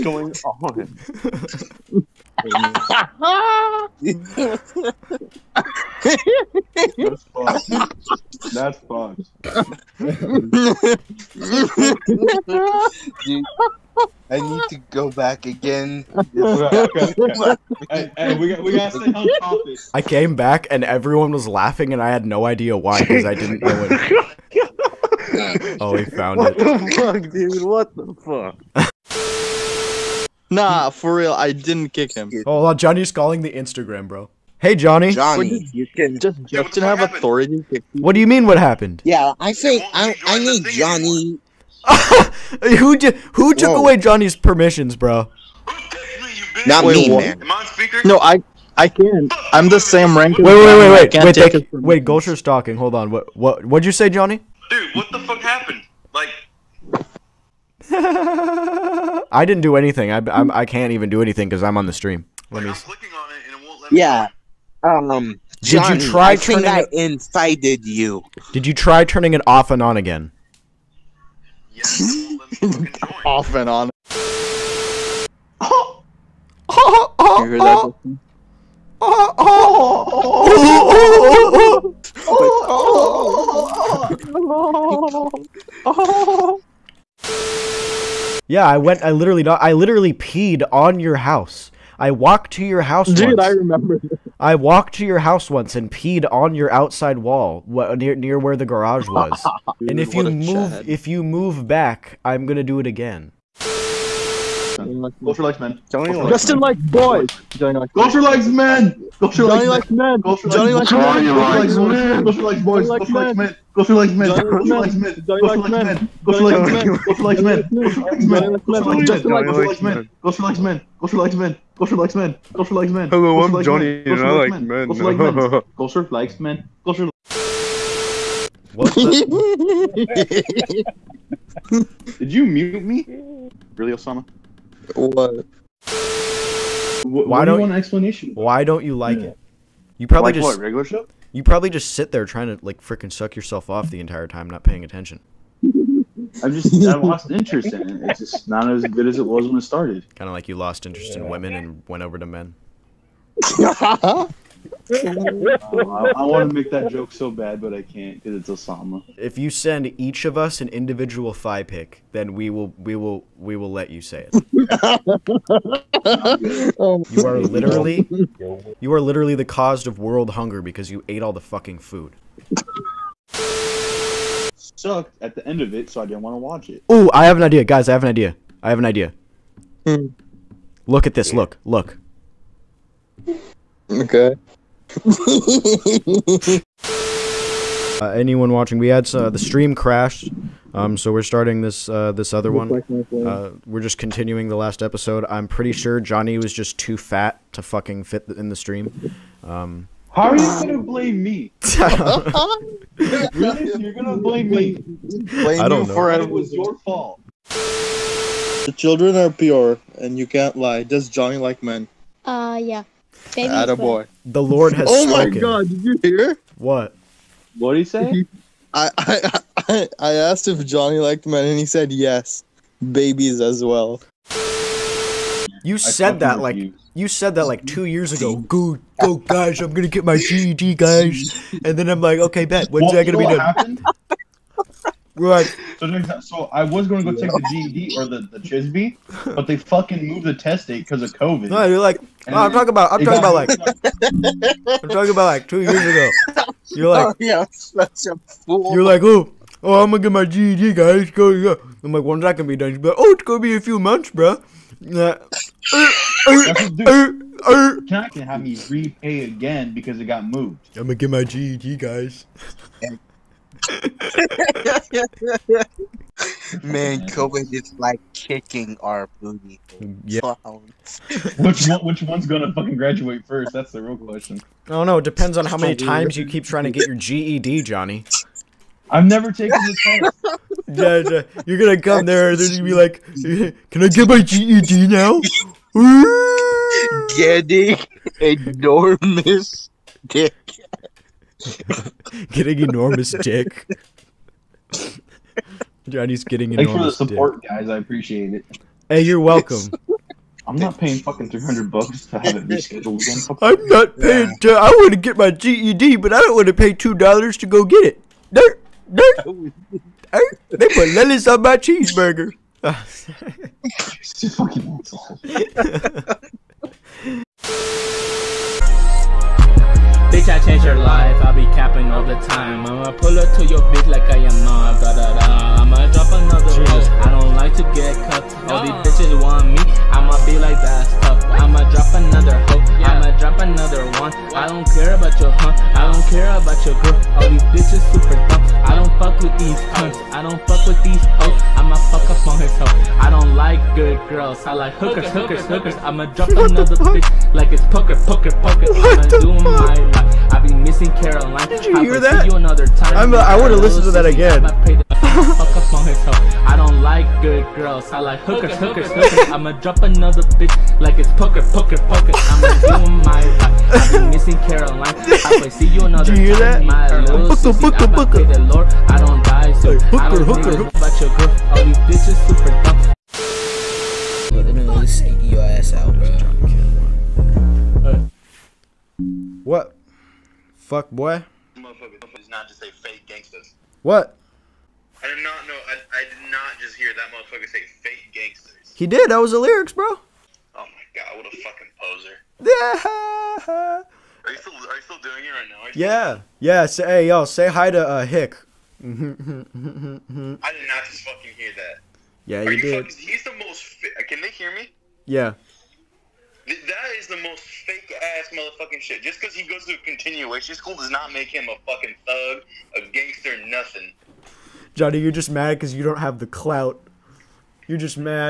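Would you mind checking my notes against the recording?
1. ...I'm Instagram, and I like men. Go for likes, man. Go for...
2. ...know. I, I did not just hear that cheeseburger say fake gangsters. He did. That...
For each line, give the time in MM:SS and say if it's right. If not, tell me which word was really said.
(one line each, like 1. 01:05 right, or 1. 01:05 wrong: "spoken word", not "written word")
1. 02:03 wrong: "Johnny", not "Instagram"
2. 06:25 wrong: "motherfucker", not "cheeseburger".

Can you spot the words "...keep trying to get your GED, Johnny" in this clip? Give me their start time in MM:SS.
04:36.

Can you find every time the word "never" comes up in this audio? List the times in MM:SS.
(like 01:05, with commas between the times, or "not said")
04:39.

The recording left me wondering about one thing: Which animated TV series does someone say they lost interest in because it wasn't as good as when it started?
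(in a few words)
Regular Show.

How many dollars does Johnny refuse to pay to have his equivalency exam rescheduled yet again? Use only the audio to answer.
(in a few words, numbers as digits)
300.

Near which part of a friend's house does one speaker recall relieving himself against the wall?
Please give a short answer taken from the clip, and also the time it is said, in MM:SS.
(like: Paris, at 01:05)
The garage, at 01:38.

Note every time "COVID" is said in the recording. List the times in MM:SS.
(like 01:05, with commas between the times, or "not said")
04:01, 04:27.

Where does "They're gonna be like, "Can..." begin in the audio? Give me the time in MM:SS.
04:42.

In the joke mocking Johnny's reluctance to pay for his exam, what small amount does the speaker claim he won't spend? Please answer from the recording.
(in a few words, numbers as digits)
2 dollars.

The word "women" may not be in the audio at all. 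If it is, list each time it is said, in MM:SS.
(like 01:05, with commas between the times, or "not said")
02:31.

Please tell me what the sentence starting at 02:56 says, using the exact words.
Oh, I have an idea, guys.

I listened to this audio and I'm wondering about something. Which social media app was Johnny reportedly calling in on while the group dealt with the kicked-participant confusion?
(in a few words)
Instagram.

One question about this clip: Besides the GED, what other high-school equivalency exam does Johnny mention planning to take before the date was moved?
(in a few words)
Chisby.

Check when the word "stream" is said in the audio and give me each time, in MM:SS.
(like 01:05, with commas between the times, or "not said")
01:01, 03:09, 03:18.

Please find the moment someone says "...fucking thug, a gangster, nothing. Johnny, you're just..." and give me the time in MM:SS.
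06:51.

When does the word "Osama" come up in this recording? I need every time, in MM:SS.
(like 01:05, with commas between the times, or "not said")
02:13, 02:38.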